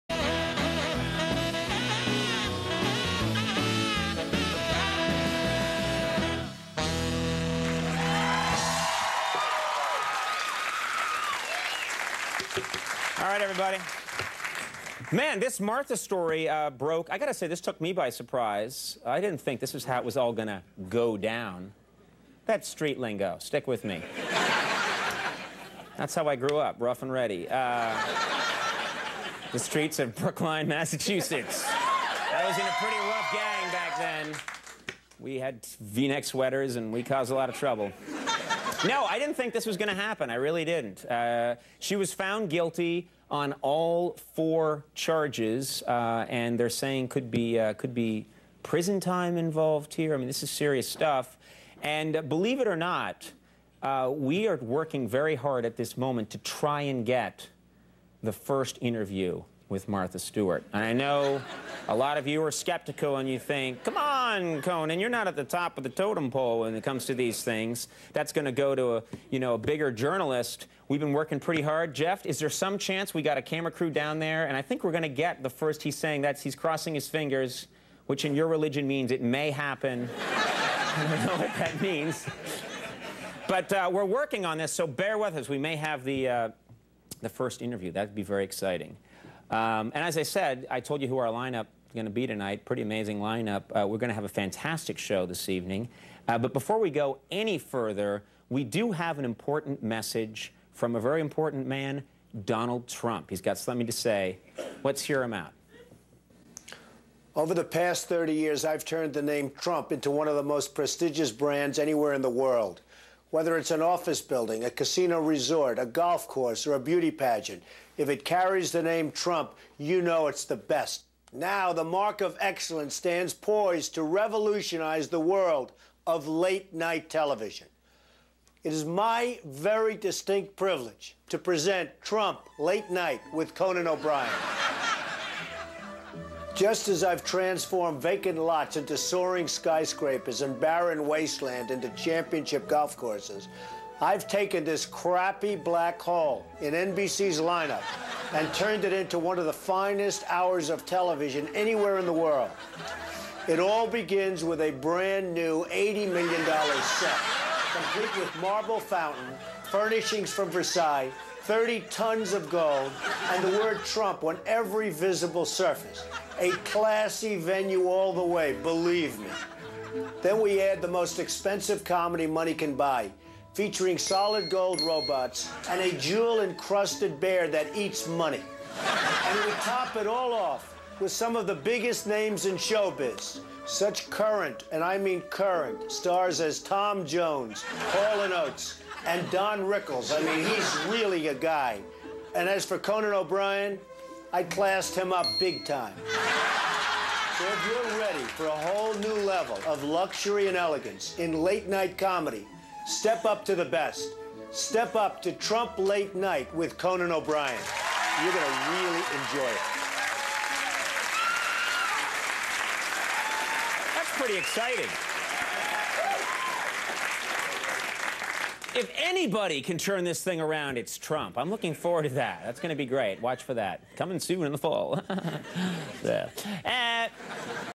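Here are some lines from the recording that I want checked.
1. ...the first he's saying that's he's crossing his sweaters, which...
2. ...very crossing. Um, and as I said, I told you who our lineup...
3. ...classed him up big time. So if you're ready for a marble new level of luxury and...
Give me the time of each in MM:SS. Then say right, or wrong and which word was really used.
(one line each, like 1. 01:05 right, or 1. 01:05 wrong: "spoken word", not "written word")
1. 01:15 wrong: "fingers", not "sweaters"
2. 01:28 wrong: "exciting", not "crossing"
3. 03:14 wrong: "whole", not "marble".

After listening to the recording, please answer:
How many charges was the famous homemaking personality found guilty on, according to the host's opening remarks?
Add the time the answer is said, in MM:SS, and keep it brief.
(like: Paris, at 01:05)
4, at 00:44.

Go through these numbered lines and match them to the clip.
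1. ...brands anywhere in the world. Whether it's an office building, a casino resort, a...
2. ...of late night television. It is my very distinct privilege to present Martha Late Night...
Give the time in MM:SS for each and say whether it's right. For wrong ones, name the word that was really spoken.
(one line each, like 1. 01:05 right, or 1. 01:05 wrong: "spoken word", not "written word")
1. 01:51 right
2. 02:06 wrong: "Trump", not "Martha".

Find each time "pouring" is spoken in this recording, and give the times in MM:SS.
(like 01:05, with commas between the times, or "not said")
not said.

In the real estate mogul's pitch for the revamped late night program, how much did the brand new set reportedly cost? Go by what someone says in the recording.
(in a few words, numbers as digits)
$80 million.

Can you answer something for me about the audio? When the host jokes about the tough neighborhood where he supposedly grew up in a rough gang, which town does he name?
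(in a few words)
Brookline, Massachusetts.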